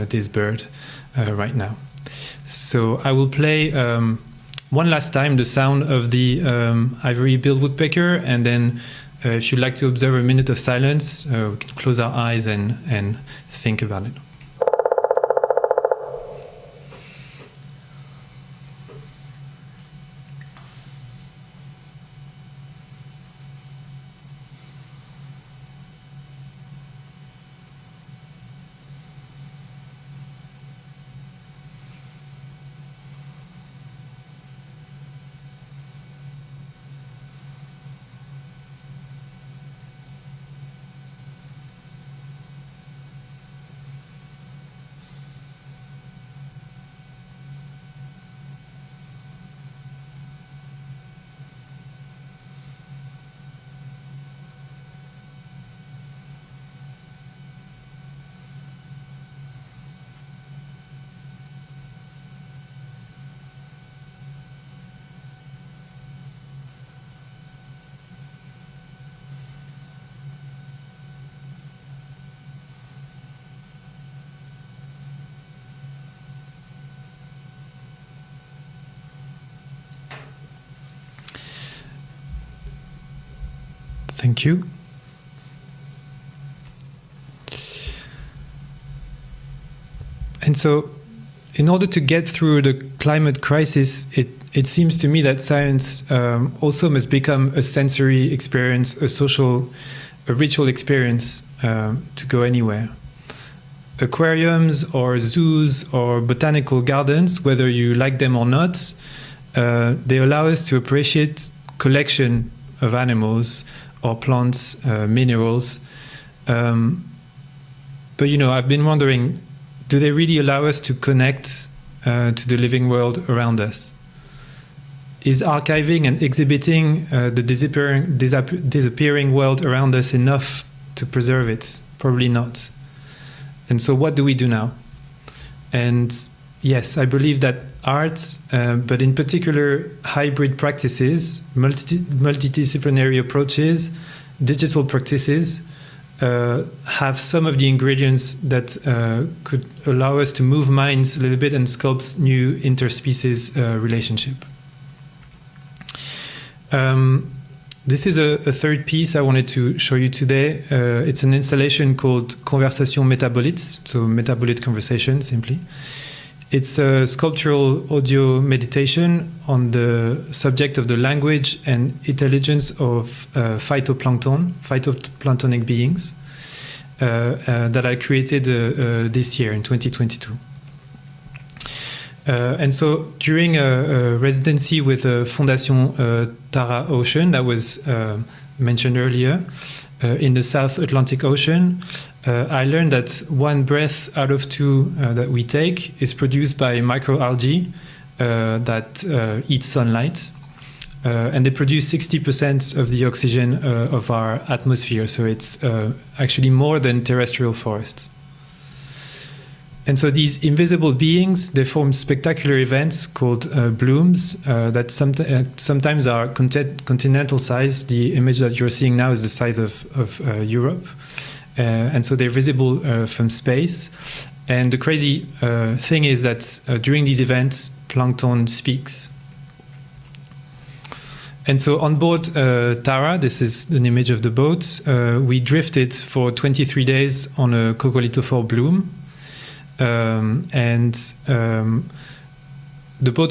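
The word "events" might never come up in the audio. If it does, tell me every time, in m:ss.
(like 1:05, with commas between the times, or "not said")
3:32, 3:47.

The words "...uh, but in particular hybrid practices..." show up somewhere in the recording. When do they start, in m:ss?
2:18.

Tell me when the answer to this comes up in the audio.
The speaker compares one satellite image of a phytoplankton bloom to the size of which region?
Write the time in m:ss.
3:40.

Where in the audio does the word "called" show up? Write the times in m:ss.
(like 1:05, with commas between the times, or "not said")
2:41, 3:33.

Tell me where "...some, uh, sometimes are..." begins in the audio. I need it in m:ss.
3:34.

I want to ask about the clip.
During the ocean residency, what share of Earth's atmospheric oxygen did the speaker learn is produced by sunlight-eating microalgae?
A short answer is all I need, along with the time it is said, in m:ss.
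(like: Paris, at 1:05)
60%, at 3:21.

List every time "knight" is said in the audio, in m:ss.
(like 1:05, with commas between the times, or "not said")
not said.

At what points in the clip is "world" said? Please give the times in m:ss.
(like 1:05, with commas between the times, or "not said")
2:02, 2:09.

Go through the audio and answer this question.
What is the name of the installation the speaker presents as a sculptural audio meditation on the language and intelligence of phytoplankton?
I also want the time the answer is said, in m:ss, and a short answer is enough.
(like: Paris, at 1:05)
Conversation Metabolites, at 2:42.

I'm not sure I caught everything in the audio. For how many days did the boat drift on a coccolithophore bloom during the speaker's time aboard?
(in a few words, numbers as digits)
23.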